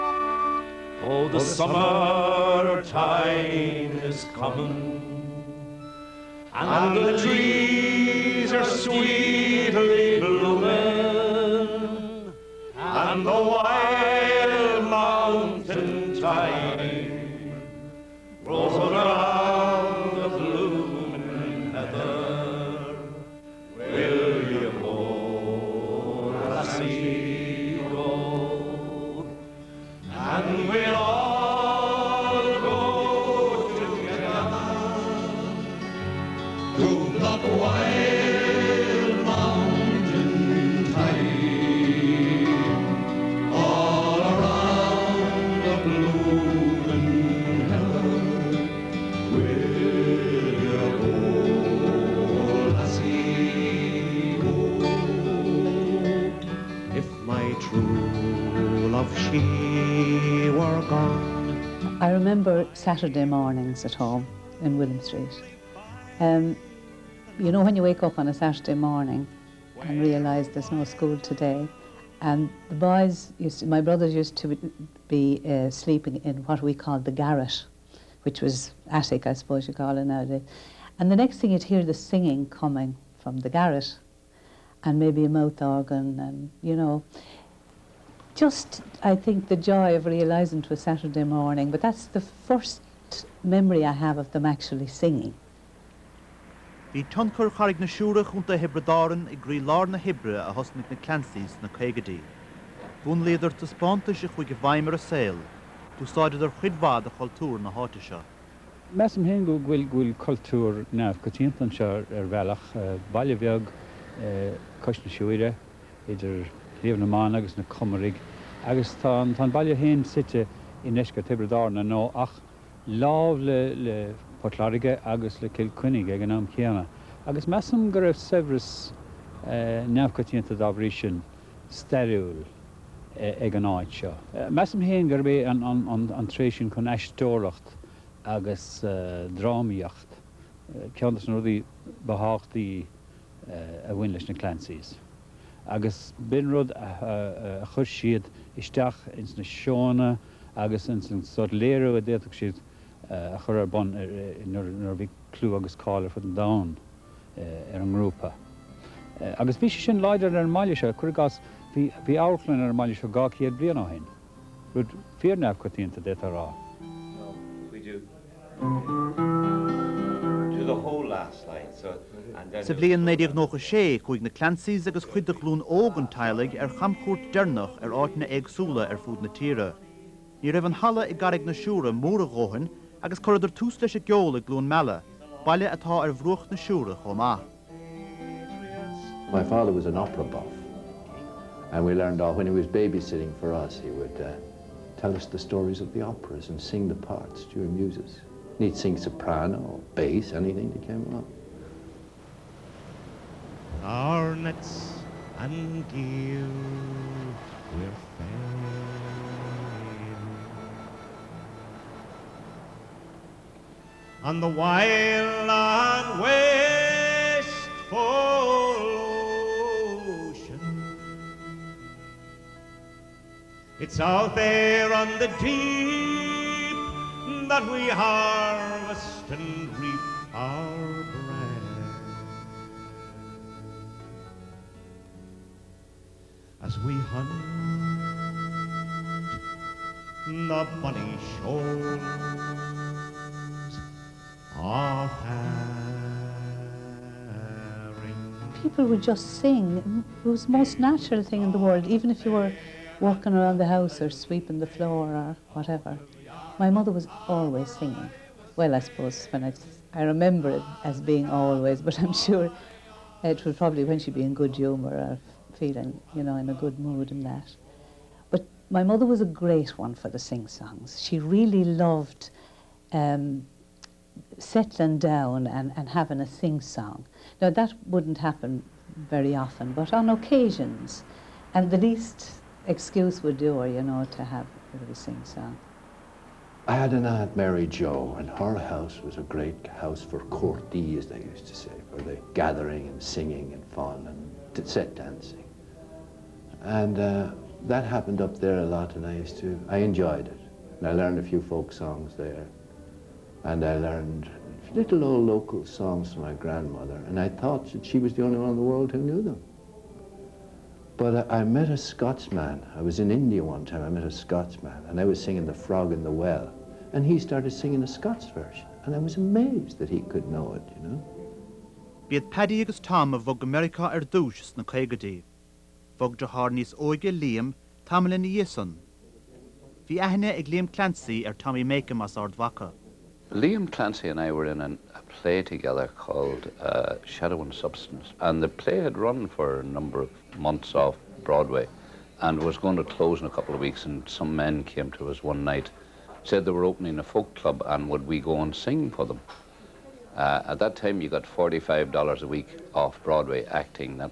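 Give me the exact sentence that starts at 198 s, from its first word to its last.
And he'd sing soprano or bass, anything that came along.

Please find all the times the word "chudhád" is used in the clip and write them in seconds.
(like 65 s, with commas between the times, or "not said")
106 s.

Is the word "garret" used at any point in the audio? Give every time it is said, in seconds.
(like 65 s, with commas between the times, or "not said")
77 s, 83 s.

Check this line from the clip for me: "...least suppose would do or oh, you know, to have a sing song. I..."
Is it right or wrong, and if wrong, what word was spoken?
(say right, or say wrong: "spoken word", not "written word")
wrong: "excuse", not "suppose".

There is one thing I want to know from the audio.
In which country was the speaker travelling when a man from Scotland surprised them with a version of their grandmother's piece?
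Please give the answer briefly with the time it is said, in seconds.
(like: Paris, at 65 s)
India, at 313 s.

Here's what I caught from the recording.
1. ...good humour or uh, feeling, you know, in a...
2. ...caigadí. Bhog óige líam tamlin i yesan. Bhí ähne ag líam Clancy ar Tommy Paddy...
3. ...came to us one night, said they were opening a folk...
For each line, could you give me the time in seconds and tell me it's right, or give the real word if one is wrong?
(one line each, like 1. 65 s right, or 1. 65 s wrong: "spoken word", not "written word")
1. 264 s right
2. 324 s wrong: "Makem", not "Paddy"
3. 344 s right.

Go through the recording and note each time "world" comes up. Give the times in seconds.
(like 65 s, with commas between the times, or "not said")
251 s, 308 s.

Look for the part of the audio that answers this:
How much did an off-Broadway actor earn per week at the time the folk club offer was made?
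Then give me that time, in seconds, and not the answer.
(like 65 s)
351 s.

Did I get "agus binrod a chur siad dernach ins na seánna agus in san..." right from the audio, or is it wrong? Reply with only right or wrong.
wrong.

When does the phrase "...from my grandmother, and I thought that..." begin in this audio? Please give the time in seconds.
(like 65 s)
306 s.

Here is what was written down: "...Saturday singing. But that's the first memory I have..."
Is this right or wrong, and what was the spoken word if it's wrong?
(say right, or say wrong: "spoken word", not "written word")
wrong: "morning", not "singing".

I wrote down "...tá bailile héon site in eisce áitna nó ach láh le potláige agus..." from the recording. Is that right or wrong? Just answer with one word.
wrong.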